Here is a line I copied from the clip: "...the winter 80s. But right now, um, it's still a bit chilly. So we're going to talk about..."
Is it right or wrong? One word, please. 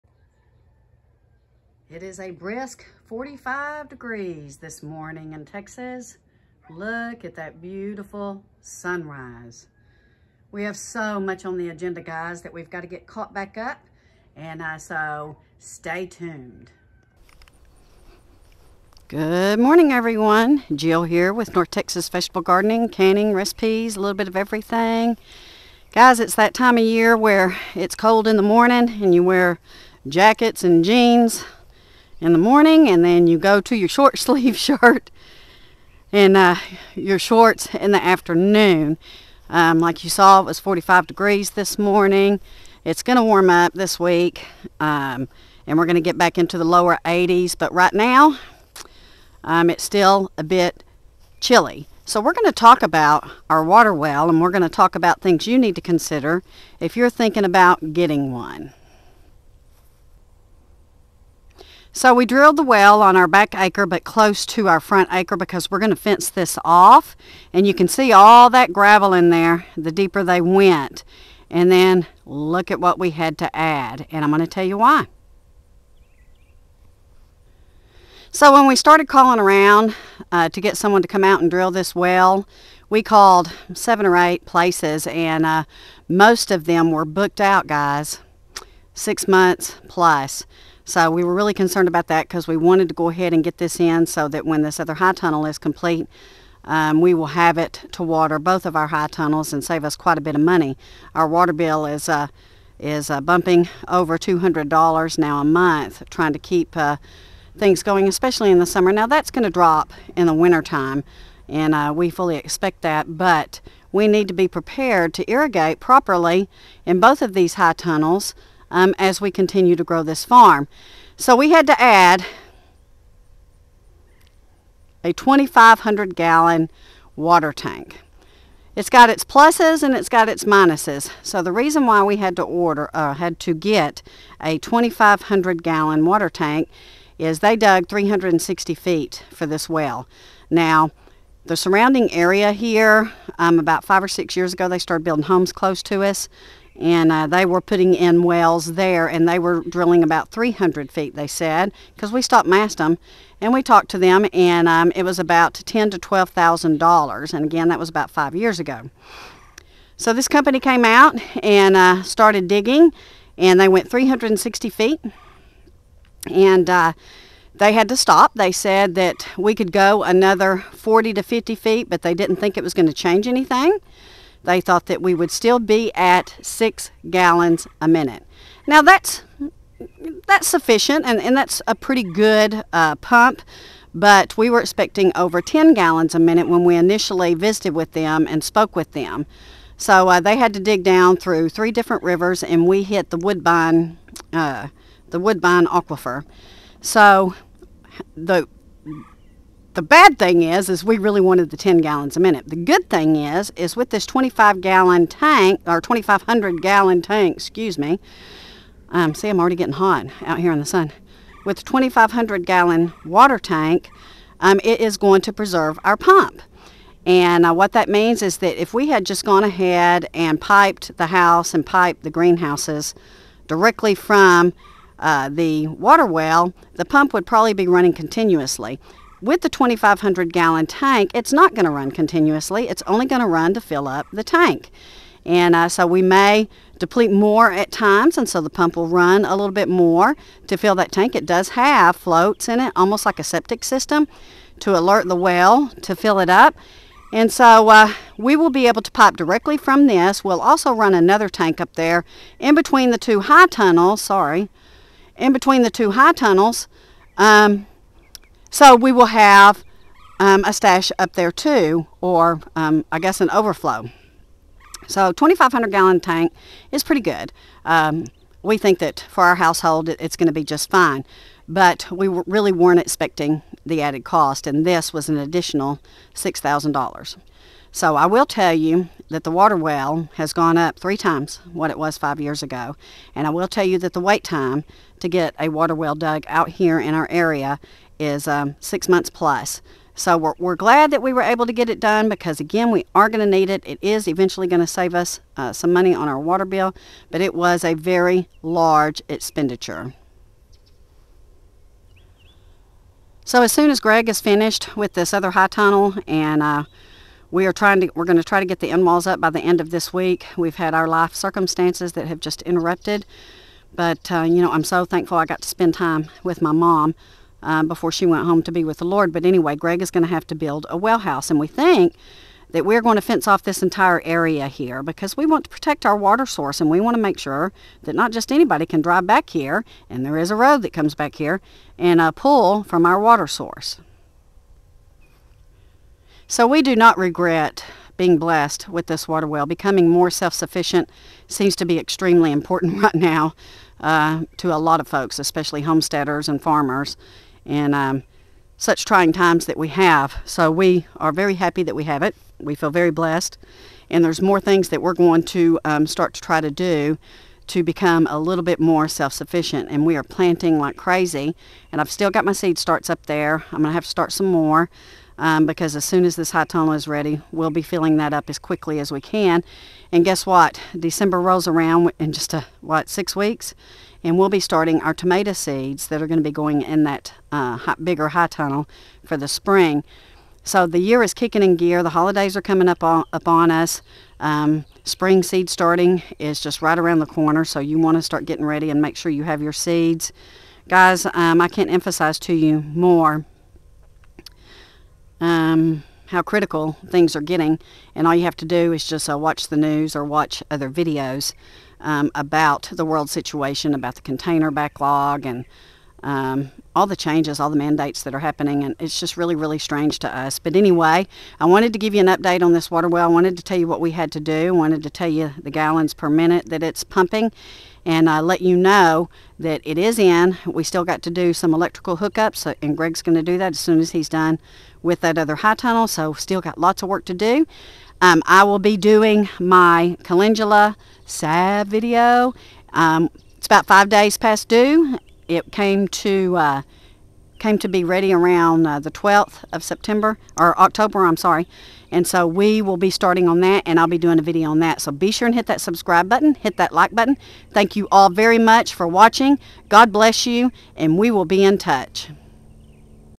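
wrong.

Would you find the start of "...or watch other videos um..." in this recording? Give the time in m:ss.
6:39.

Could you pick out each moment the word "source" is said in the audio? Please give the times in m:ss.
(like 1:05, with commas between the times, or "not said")
5:26, 5:33.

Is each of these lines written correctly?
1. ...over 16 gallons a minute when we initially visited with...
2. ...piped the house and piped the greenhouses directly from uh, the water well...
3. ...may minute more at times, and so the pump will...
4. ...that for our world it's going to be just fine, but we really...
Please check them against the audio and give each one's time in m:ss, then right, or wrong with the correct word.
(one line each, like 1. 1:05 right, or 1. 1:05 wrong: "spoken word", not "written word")
1. 3:05 wrong: "10", not "16"
2. 3:40 right
3. 3:56 wrong: "deplete", not "minute"
4. 4:28 wrong: "household", not "world".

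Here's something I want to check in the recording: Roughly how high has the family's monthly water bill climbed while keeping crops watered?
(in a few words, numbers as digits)
$200.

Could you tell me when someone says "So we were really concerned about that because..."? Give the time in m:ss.
1:30.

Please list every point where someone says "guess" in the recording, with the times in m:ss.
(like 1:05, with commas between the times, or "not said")
4:22, 6:10.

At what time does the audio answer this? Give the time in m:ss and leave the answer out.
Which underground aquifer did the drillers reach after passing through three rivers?
3:15.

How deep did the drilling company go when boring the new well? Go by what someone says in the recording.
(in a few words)
360 feet.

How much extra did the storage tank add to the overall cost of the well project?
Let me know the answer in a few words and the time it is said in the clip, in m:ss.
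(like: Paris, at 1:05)
$6,000, at 4:36.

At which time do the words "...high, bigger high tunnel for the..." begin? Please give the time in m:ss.
6:17.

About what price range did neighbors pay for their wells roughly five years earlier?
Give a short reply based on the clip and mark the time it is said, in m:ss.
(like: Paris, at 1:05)
$10,000 to $12,000, at 2:35.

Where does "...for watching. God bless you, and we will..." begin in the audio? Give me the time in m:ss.
7:28.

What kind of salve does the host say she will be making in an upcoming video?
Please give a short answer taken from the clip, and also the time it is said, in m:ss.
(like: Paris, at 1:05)
calendula salve, at 7:10.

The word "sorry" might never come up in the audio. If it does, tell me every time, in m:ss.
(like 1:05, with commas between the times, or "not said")
4:14, 7:21.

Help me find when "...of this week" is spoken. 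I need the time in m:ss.
5:09.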